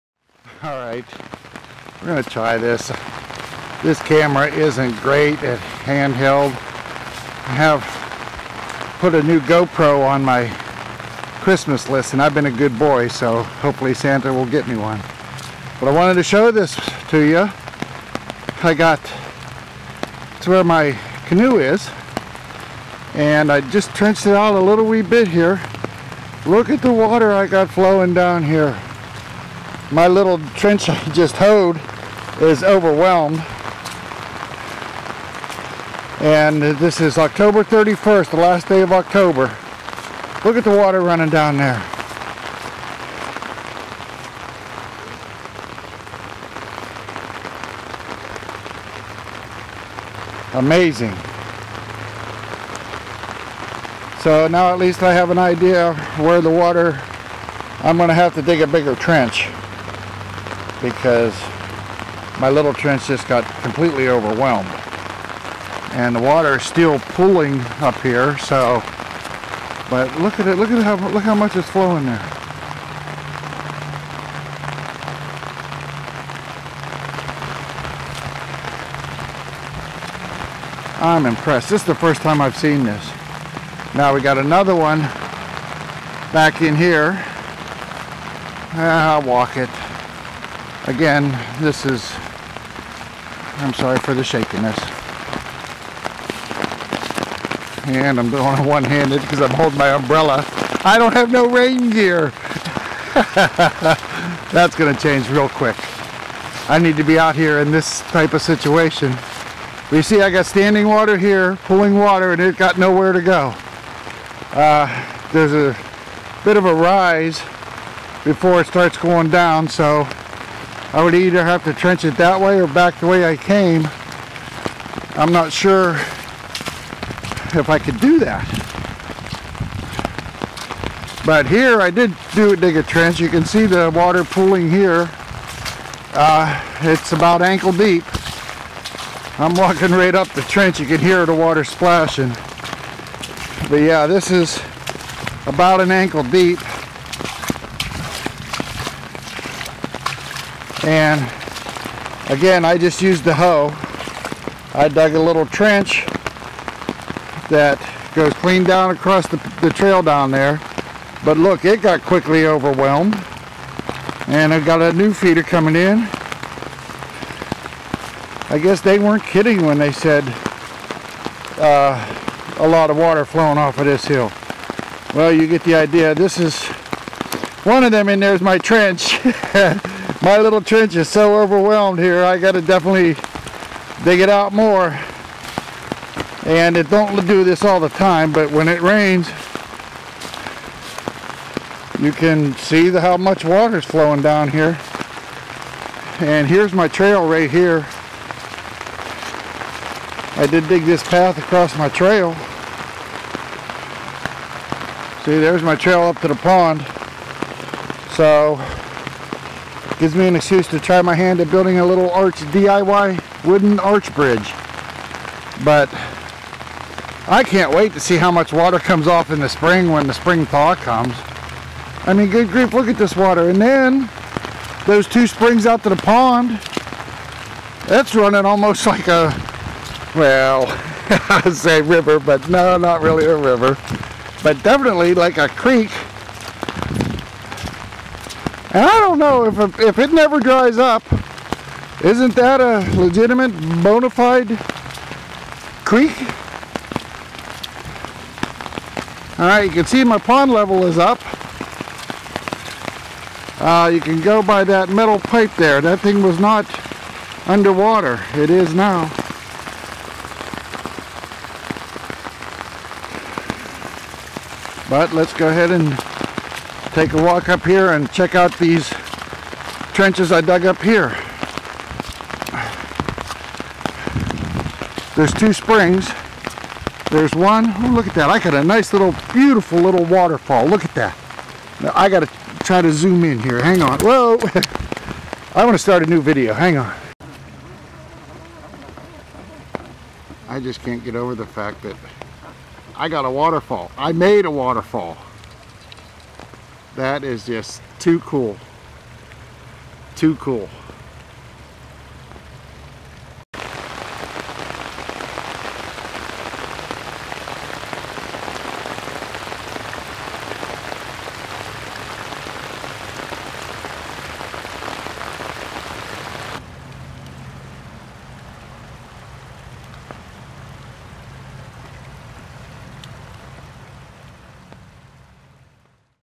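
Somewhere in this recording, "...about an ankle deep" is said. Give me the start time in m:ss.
2:25.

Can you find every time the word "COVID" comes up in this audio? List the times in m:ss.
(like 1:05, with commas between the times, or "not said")
not said.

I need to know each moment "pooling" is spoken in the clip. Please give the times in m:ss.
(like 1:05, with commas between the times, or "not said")
1:06, 2:14.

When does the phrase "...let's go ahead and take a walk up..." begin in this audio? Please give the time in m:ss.
4:25.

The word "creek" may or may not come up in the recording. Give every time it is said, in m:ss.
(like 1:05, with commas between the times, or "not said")
3:55, 4:05.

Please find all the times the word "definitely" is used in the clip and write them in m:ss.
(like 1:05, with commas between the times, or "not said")
3:02, 3:54.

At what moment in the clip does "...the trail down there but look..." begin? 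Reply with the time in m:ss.
2:39.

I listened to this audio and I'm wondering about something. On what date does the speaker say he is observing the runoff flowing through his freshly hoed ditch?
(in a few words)
October 31st.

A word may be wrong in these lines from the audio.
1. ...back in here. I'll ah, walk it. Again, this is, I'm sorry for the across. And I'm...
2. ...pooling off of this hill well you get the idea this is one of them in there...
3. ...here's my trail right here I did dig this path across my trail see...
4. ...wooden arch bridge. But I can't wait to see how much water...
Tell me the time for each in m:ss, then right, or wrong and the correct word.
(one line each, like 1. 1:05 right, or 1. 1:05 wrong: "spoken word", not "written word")
1. 1:26 wrong: "shakiness", not "across"
2. 2:53 wrong: "flowing", not "pooling"
3. 3:16 right
4. 3:33 right.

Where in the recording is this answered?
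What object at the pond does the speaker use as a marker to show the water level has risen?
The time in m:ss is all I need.
4:14.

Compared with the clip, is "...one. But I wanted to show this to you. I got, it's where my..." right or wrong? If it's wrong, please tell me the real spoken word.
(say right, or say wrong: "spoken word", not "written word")
right.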